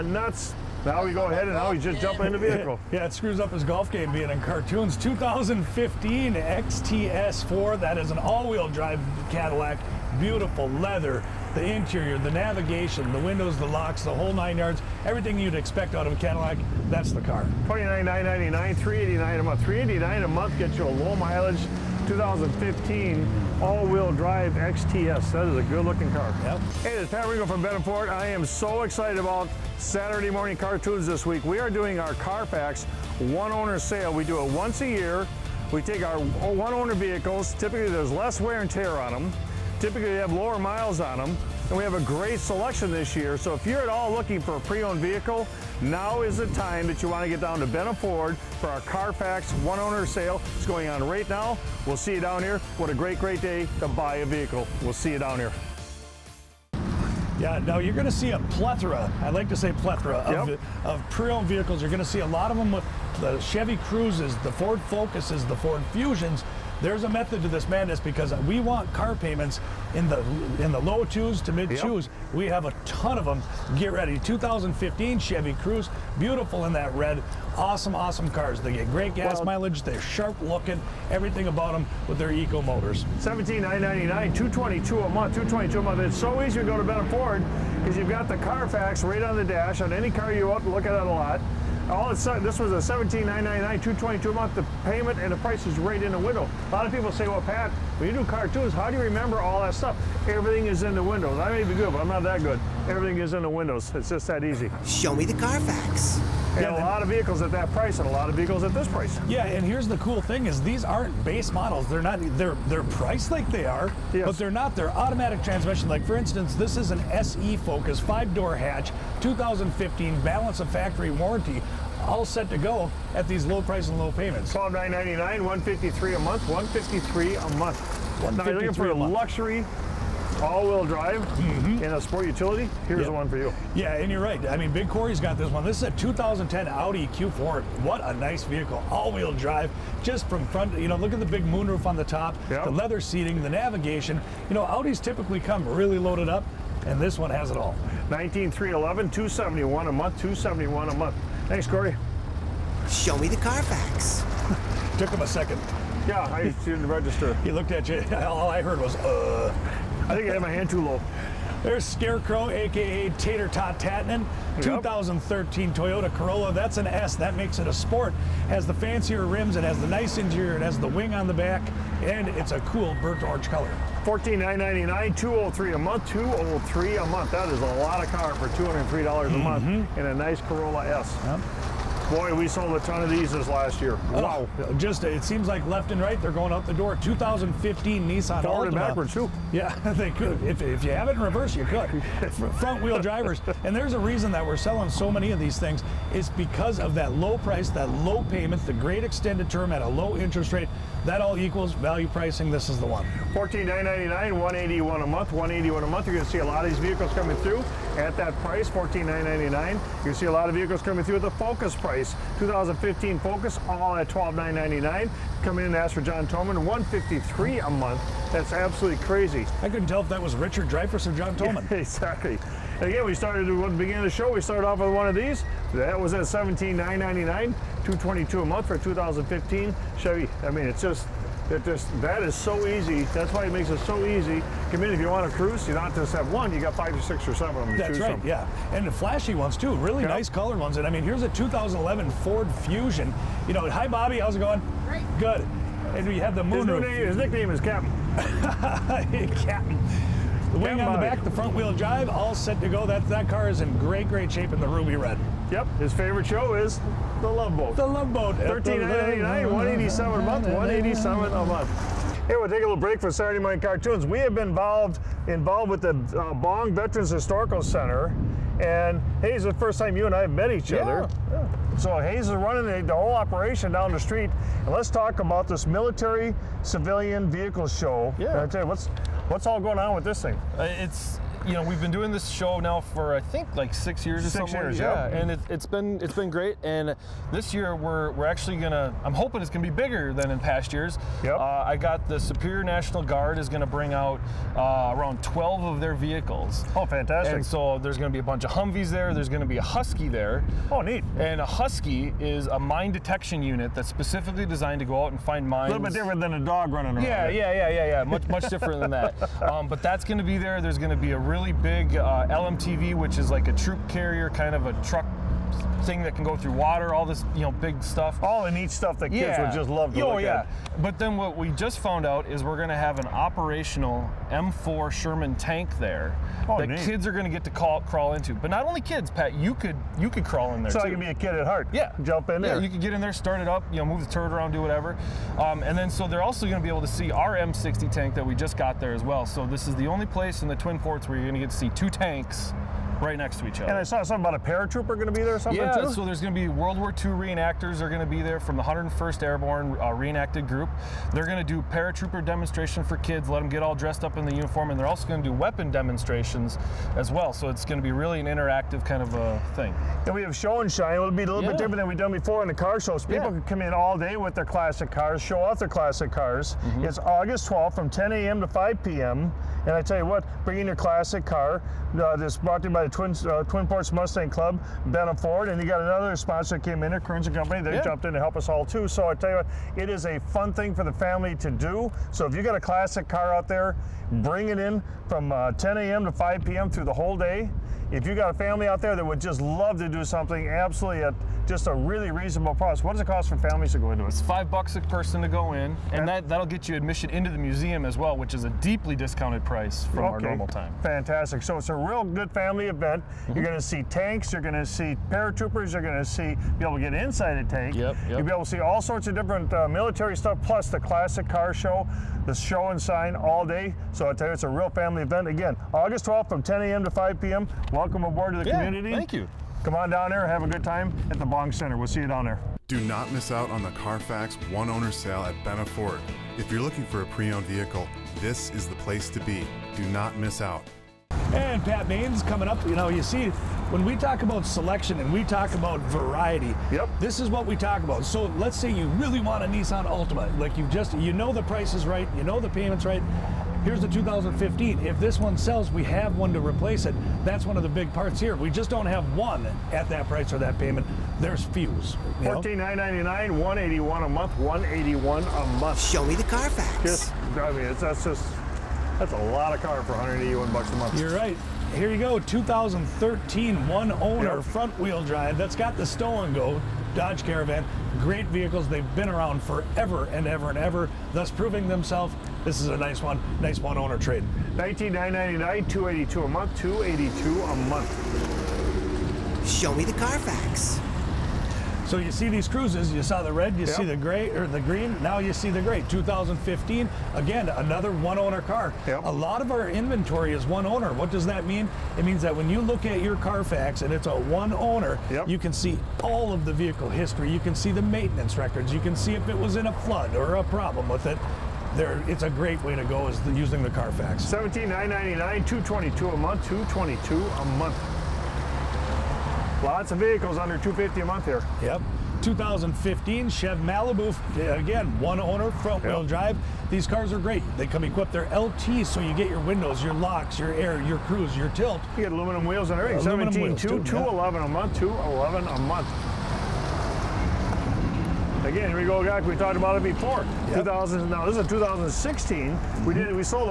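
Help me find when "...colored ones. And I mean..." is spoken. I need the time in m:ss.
4:00.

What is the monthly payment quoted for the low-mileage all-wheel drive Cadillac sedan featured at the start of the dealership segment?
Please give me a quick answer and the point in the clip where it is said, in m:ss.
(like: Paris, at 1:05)
$389, at 0:19.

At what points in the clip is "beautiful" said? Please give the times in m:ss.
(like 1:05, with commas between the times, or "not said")
0:10, 1:16.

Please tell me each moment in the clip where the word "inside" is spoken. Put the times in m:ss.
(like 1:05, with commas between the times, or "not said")
6:47.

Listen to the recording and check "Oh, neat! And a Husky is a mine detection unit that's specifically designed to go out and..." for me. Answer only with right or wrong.
right.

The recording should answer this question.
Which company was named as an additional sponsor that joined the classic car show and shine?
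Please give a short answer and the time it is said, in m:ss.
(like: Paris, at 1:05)
Kearns and Company, at 6:16.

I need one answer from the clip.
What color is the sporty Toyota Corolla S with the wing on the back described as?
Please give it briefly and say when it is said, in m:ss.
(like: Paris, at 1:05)
burnt orange, at 2:52.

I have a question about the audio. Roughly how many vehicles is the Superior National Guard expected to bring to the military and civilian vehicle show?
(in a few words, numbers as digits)
12.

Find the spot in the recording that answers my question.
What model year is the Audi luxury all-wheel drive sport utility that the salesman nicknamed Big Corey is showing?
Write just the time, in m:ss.
2:15.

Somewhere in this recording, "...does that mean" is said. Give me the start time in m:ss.
8:11.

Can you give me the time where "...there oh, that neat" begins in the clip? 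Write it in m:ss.
5:25.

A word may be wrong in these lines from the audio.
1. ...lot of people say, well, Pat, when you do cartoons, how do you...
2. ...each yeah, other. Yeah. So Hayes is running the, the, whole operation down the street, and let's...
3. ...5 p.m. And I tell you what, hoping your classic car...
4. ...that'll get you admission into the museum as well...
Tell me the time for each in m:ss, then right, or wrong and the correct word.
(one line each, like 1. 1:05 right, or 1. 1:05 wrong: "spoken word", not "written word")
1. 1:36 right
2. 4:30 right
3. 6:08 wrong: "bringing", not "hoping"
4. 6:36 right.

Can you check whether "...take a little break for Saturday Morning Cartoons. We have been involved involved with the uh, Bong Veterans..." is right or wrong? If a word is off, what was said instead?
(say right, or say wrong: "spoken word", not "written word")
right.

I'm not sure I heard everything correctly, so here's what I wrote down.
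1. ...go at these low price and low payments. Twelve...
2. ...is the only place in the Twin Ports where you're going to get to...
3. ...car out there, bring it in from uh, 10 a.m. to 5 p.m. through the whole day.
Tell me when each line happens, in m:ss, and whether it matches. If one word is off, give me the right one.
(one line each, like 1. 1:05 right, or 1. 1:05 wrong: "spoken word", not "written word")
1. 2:02 right
2. 5:39 right
3. 6:23 right.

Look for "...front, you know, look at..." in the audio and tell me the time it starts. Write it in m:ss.
2:20.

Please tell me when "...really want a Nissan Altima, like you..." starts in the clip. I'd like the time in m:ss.
7:18.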